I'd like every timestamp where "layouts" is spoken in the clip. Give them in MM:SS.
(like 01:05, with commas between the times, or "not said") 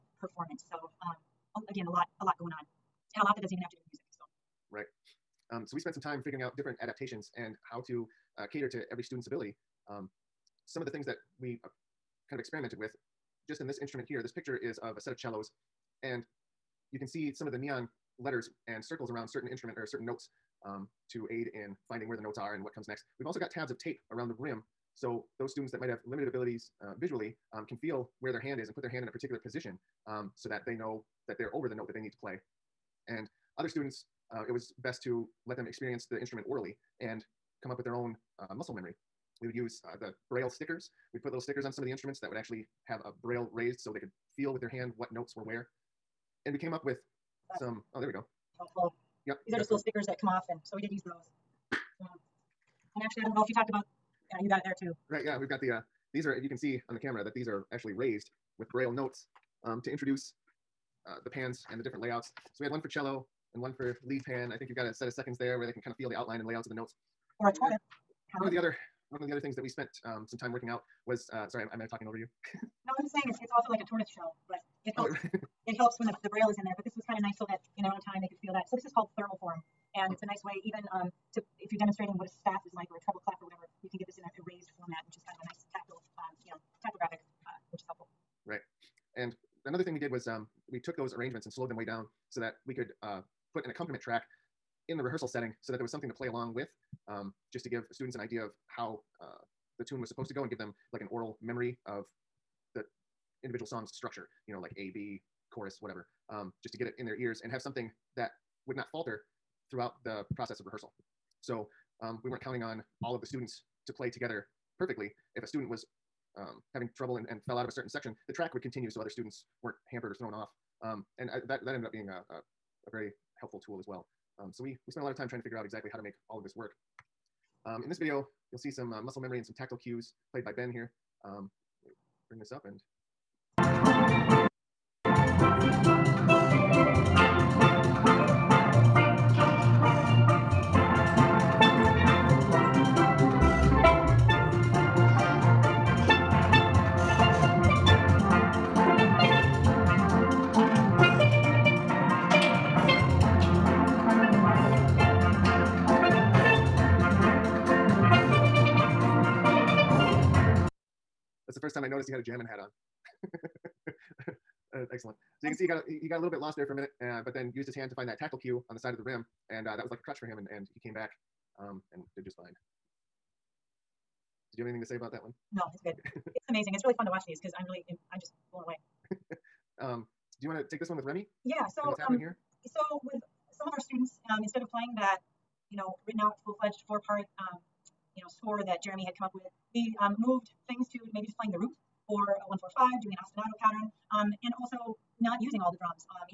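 01:02, 01:06.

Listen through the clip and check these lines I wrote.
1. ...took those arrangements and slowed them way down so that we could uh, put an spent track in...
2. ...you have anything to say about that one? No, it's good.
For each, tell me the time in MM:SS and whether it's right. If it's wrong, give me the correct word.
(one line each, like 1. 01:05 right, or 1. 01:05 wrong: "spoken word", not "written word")
1. 01:30 wrong: "accompaniment", not "spent"
2. 02:54 right.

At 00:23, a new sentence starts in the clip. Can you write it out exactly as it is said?
We've also got tabs of tape around the rim.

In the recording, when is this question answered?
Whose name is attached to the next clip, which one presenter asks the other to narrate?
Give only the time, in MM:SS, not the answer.
03:01.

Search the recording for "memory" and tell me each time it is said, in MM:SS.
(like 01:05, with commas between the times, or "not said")
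00:38, 01:41, 02:09.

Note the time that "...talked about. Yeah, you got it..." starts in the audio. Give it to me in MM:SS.
00:53.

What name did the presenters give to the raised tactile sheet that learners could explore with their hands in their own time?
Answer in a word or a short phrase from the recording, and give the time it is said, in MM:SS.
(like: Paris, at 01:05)
Thermoform, at 01:19.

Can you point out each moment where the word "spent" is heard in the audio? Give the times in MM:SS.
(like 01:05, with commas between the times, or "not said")
00:05, 01:09, 02:04.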